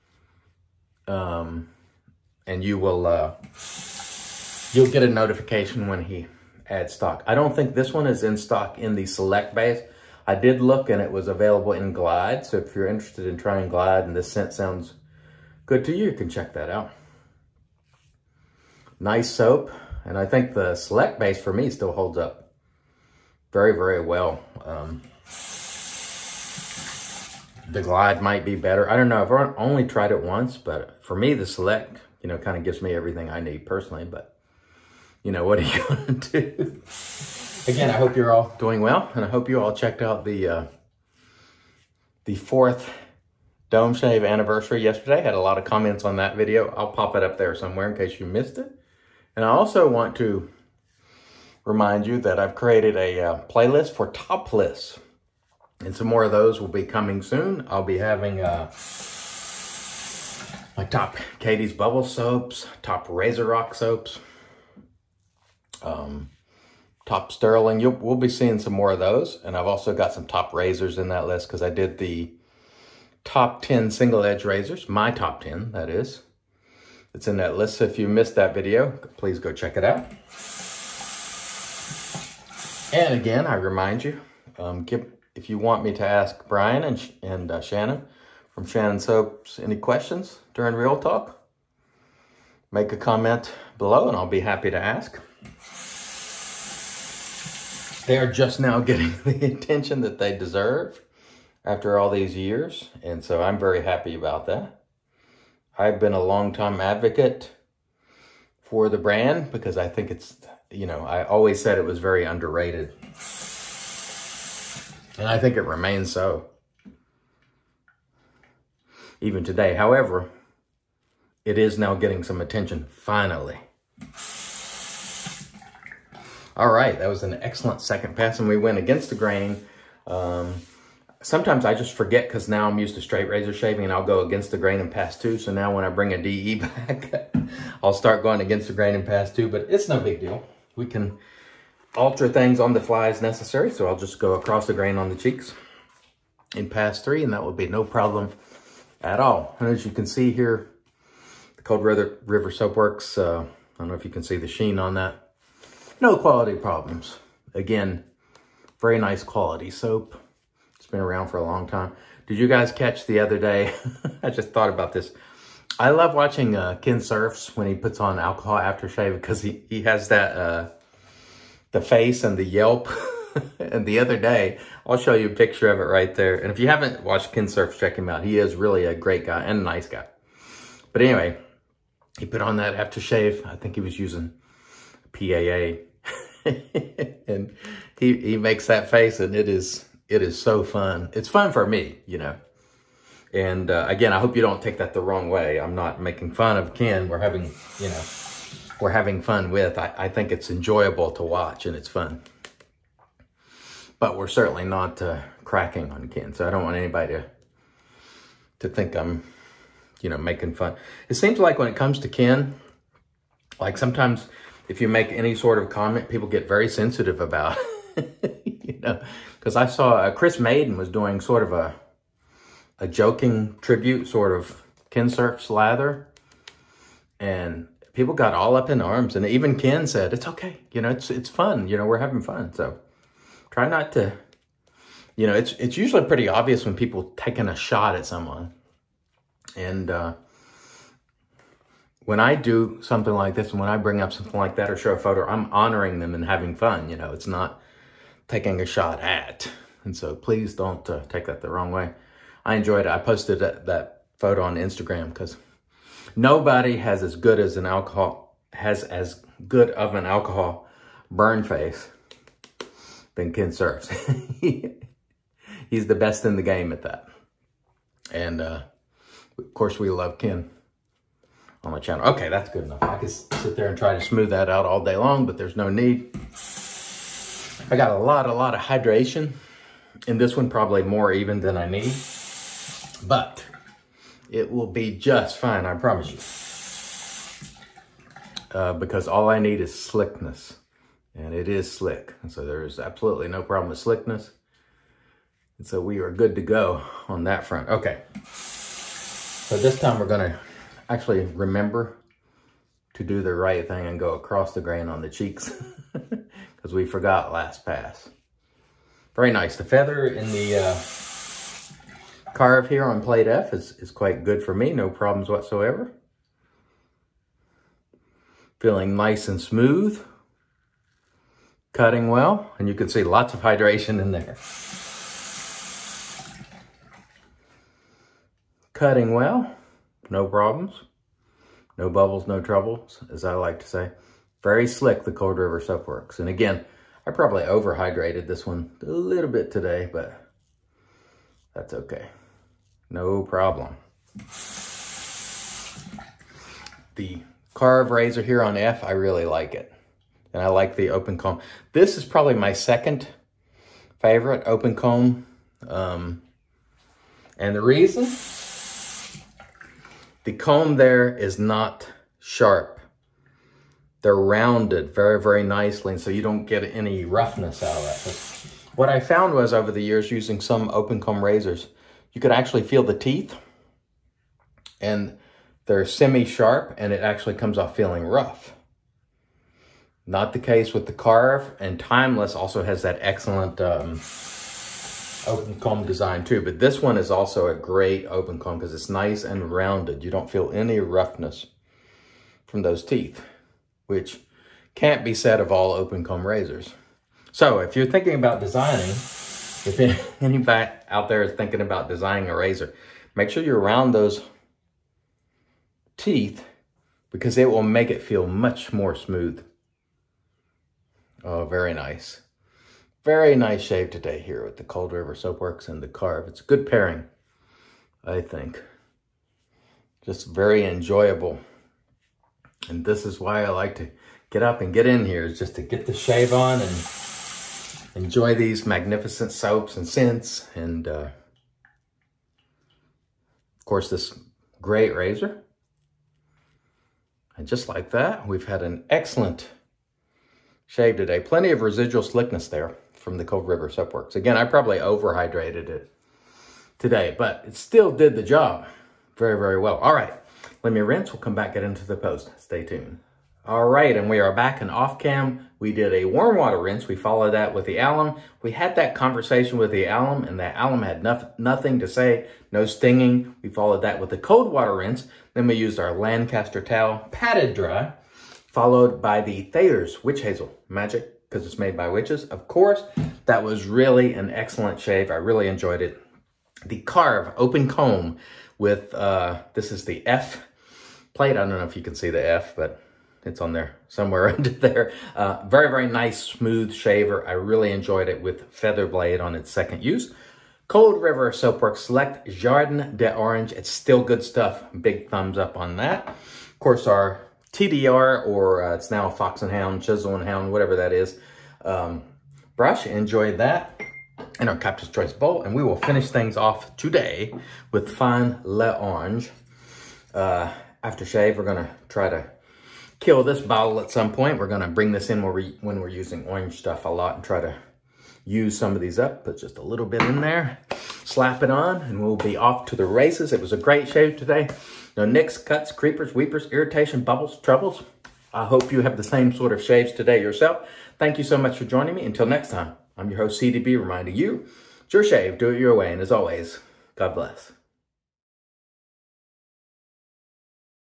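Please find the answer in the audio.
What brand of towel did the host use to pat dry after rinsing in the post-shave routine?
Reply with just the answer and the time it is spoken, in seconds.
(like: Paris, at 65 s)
Lancaster, at 465 s.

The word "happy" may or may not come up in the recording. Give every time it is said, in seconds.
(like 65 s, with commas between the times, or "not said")
94 s, 103 s.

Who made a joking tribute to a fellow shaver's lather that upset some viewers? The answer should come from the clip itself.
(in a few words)
Chris Maiden.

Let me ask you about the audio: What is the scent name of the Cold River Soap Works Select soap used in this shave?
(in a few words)
Jardin d'Orange.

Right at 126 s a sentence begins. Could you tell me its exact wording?
All right, that was an excellent second pass, and we went against the grain.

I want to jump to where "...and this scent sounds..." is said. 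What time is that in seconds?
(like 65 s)
14 s.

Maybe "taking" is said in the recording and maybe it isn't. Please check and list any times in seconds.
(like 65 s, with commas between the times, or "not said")
237 s, 248 s.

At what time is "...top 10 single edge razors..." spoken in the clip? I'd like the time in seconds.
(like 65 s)
73 s.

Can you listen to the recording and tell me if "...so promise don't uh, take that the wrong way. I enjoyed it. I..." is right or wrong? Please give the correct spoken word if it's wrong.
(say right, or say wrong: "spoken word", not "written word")
wrong: "please", not "promise".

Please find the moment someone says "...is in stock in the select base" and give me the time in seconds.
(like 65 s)
8 s.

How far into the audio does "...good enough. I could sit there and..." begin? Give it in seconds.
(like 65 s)
272 s.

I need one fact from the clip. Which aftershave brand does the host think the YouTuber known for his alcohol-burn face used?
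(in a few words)
PAA.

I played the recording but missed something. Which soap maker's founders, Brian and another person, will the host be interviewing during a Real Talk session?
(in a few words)
Shannon Soaps.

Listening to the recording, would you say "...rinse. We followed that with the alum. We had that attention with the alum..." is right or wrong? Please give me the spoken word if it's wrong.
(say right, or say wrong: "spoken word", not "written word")
wrong: "conversation", not "attention".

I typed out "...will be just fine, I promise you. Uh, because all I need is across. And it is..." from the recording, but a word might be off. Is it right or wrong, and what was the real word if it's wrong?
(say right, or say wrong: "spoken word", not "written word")
wrong: "slickness", not "across".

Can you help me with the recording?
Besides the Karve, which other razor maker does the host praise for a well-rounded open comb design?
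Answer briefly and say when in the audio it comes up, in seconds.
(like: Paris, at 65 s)
Timeless, at 381 s.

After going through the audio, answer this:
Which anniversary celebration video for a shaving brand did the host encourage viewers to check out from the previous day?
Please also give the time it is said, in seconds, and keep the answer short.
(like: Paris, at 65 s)
Dome Shave, at 42 s.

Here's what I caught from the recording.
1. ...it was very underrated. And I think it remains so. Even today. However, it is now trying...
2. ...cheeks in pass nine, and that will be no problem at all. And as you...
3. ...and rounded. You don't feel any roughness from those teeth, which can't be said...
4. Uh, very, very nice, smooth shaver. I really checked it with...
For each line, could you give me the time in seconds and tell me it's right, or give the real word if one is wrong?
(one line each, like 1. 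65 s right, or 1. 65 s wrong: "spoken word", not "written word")
1. 111 s wrong: "getting", not "trying"
2. 145 s wrong: "three", not "nine"
3. 389 s right
4. 485 s wrong: "enjoyed", not "checked".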